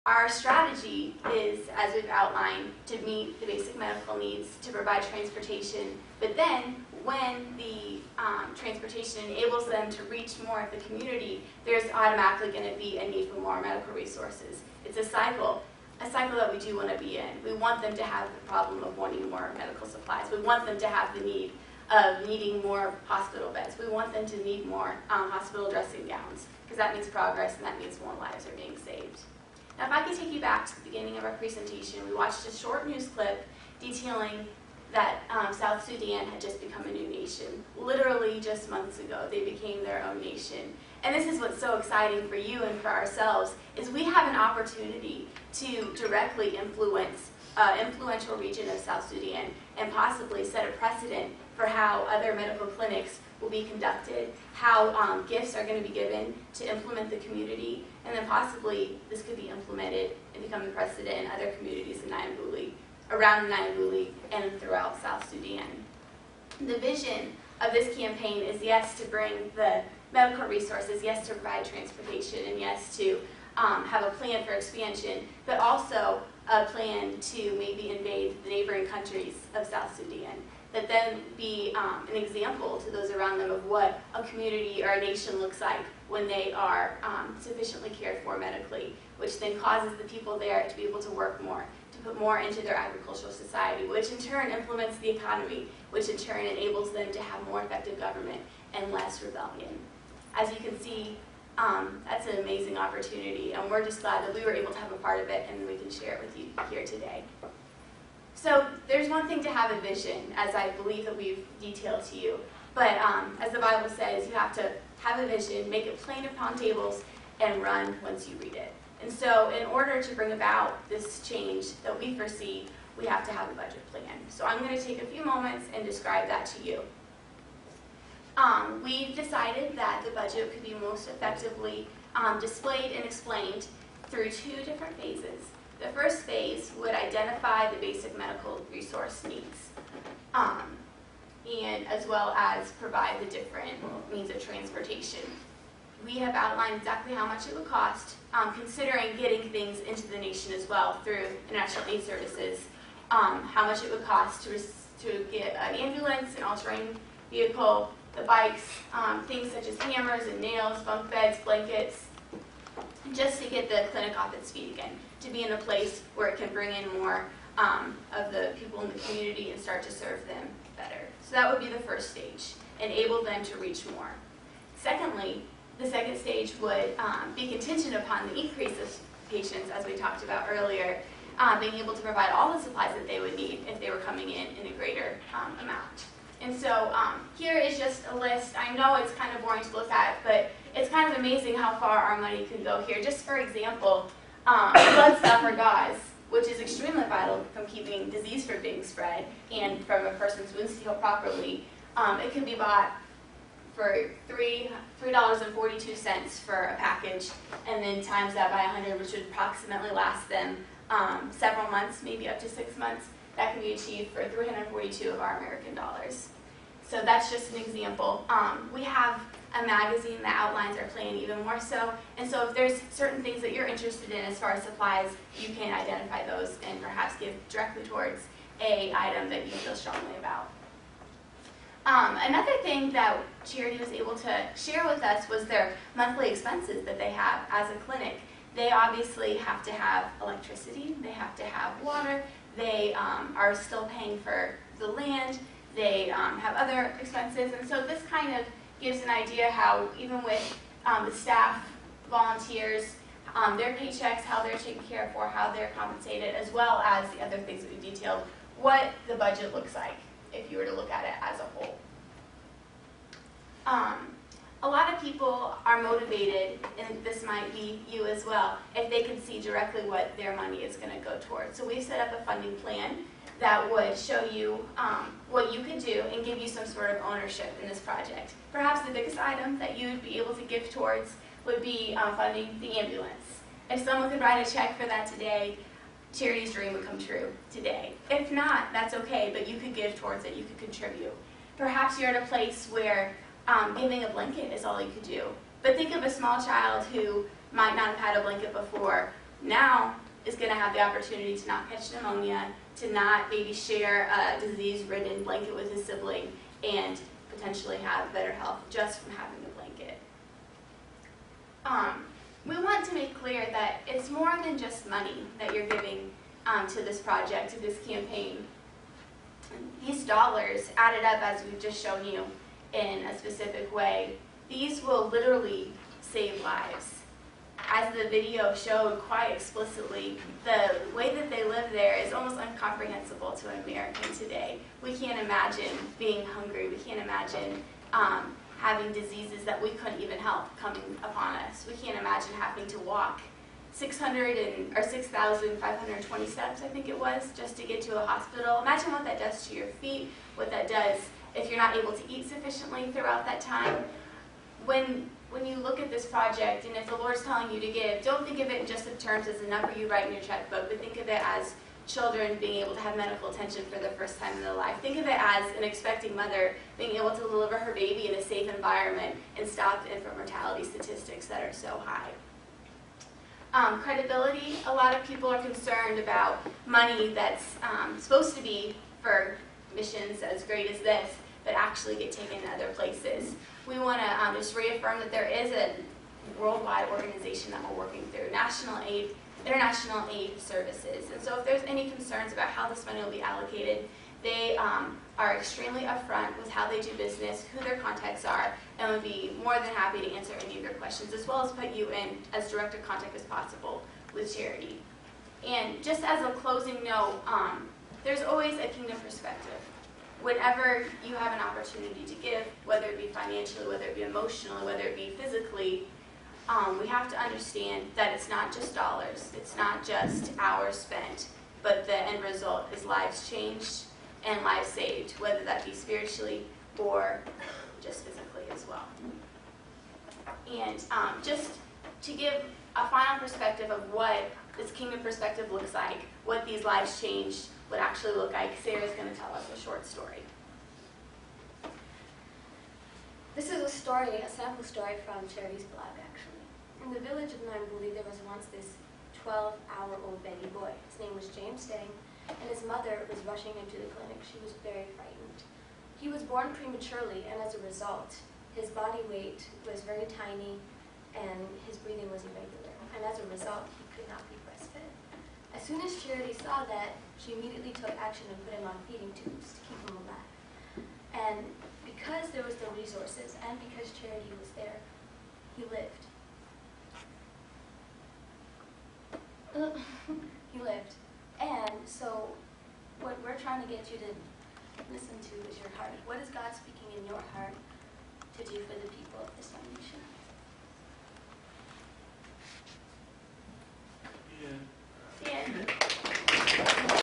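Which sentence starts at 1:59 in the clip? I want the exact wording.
And so in order to bring about this change that we foresee, we have to have a budget plan.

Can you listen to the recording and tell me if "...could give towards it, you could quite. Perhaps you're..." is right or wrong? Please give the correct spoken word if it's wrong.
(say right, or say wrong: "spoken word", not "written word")
wrong: "contribute", not "quite".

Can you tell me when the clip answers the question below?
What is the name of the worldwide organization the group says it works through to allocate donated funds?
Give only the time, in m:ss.
6:29.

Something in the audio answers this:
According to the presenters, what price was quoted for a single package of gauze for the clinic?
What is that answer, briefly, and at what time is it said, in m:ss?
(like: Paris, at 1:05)
$3.42, at 3:24.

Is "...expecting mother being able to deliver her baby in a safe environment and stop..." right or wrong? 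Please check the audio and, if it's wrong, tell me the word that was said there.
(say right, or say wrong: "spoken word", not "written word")
right.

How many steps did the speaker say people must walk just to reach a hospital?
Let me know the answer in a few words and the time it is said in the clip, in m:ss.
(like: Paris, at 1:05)
6,520, at 5:44.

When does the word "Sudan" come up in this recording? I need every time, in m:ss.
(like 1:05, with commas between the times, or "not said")
0:35, 0:49, 1:05, 1:19.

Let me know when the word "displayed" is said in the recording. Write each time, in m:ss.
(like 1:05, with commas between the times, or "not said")
2:12.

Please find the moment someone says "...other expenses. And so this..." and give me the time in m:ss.
4:06.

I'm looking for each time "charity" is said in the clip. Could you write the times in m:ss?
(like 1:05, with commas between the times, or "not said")
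3:53, 4:46, 6:44, 7:25, 7:46, 7:53.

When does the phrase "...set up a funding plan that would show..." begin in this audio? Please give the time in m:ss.
4:31.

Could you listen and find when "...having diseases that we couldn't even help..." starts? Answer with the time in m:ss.
5:38.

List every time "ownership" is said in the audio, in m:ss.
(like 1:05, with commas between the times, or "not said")
4:37.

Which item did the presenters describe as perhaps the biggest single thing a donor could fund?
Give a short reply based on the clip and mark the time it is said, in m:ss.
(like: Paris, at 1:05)
the ambulance, at 4:42.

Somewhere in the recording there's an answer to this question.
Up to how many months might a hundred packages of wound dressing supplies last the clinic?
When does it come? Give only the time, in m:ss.
3:32.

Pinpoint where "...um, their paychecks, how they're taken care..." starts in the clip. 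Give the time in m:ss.
4:13.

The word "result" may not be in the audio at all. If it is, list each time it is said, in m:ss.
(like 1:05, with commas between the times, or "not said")
7:02, 7:37, 7:43.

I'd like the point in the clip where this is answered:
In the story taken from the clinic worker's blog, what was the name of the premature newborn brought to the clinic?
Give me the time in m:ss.
7:31.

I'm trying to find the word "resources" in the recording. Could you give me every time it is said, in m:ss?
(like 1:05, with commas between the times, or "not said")
0:13, 1:10, 2:18, 7:52.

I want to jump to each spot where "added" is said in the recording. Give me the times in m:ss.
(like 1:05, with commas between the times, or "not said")
5:20.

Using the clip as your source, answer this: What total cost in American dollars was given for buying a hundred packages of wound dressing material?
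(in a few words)
342.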